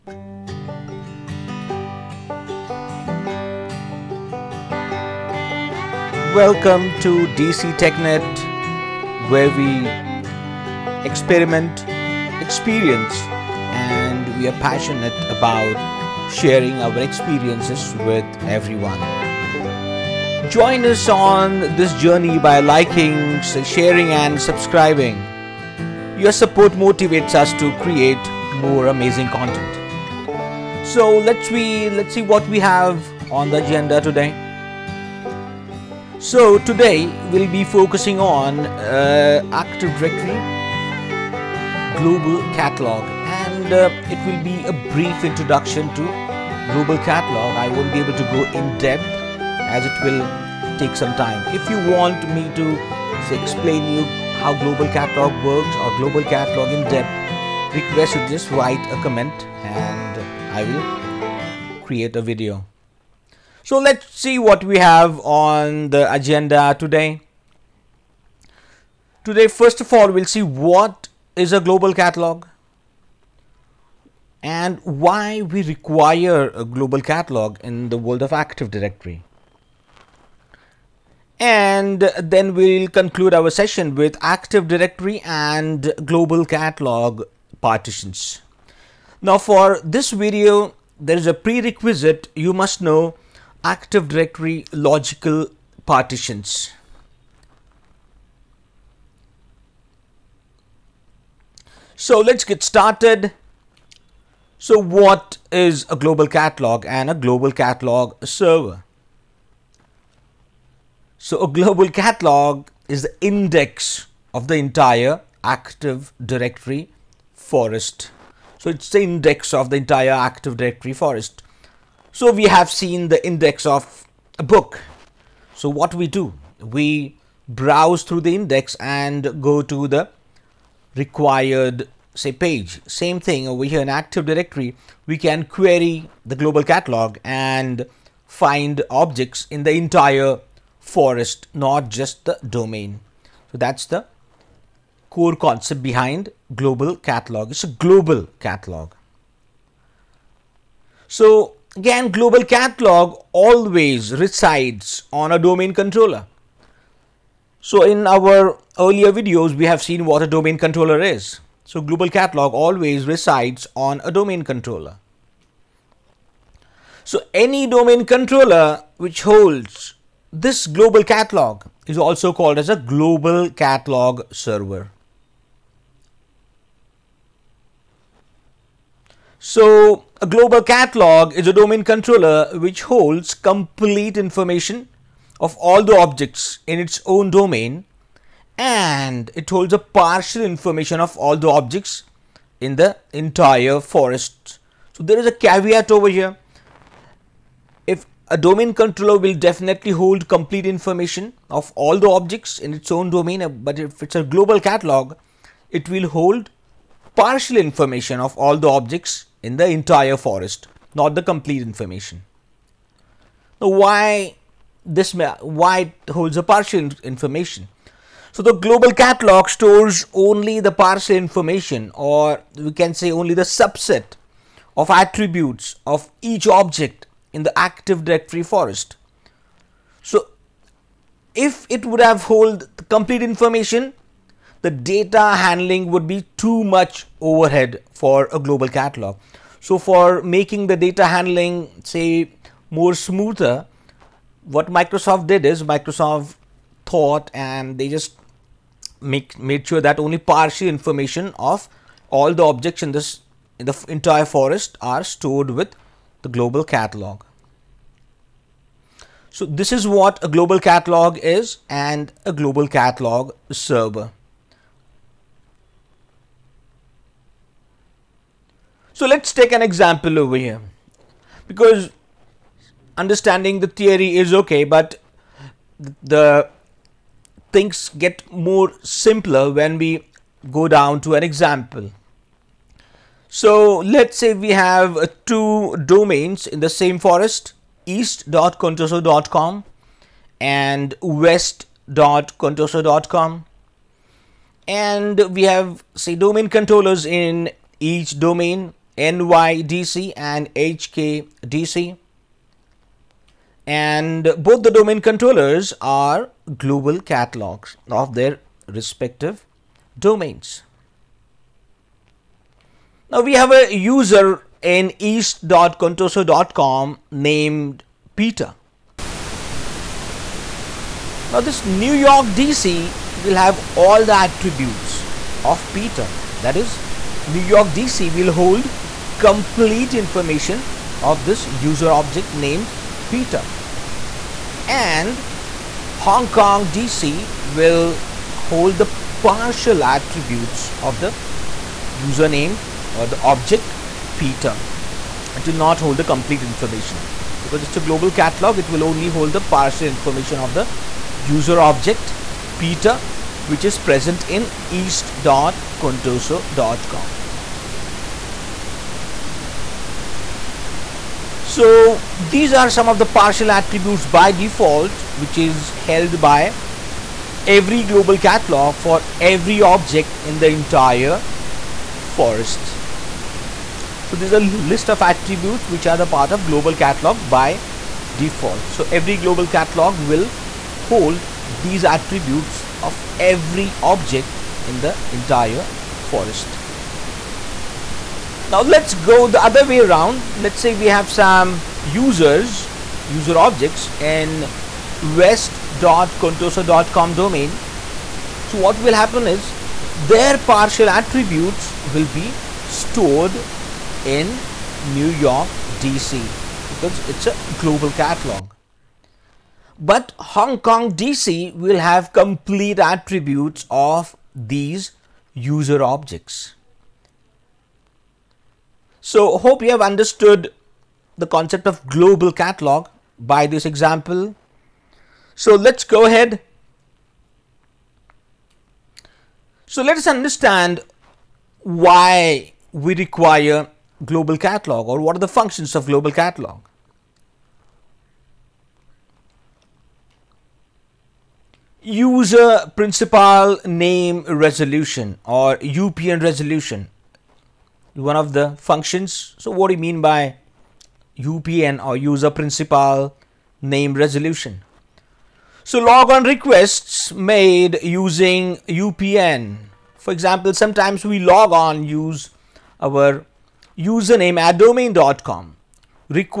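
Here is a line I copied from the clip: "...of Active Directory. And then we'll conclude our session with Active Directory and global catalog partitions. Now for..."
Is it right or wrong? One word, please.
right.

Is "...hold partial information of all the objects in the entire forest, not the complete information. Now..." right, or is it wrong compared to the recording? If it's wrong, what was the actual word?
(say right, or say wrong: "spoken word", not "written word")
right.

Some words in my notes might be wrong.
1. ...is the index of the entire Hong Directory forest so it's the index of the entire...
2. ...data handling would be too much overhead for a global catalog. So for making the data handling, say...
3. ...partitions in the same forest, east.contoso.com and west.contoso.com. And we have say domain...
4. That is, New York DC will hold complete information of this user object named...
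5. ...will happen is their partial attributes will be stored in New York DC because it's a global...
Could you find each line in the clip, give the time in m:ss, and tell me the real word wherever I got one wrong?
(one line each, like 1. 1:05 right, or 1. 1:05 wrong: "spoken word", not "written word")
1. 1:52 wrong: "Active", not "Hong"
2. 3:54 right
3. 4:45 wrong: "domains", not "partitions"
4. 5:26 right
5. 6:38 right.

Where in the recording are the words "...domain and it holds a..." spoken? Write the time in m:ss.
3:07.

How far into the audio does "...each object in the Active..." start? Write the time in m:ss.
3:46.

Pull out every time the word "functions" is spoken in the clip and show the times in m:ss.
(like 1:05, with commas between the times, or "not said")
7:15, 7:28.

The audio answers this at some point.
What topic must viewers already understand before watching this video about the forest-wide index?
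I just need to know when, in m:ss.
1:33.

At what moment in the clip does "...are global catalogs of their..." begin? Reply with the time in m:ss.
5:05.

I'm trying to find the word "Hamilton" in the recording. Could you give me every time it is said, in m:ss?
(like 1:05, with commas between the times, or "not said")
not said.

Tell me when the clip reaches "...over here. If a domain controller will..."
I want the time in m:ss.
3:15.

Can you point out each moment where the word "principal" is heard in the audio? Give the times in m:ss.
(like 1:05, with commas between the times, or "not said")
7:22, 7:32.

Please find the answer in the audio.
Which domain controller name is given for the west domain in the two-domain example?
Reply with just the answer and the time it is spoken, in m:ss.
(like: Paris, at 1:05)
HKDC, at 5:00.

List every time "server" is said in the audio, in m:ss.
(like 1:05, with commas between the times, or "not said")
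1:48, 2:54, 4:23.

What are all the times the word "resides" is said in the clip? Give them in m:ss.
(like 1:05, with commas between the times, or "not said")
2:34, 2:43.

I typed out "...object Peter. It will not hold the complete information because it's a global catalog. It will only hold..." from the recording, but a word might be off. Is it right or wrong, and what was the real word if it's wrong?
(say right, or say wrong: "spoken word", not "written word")
right.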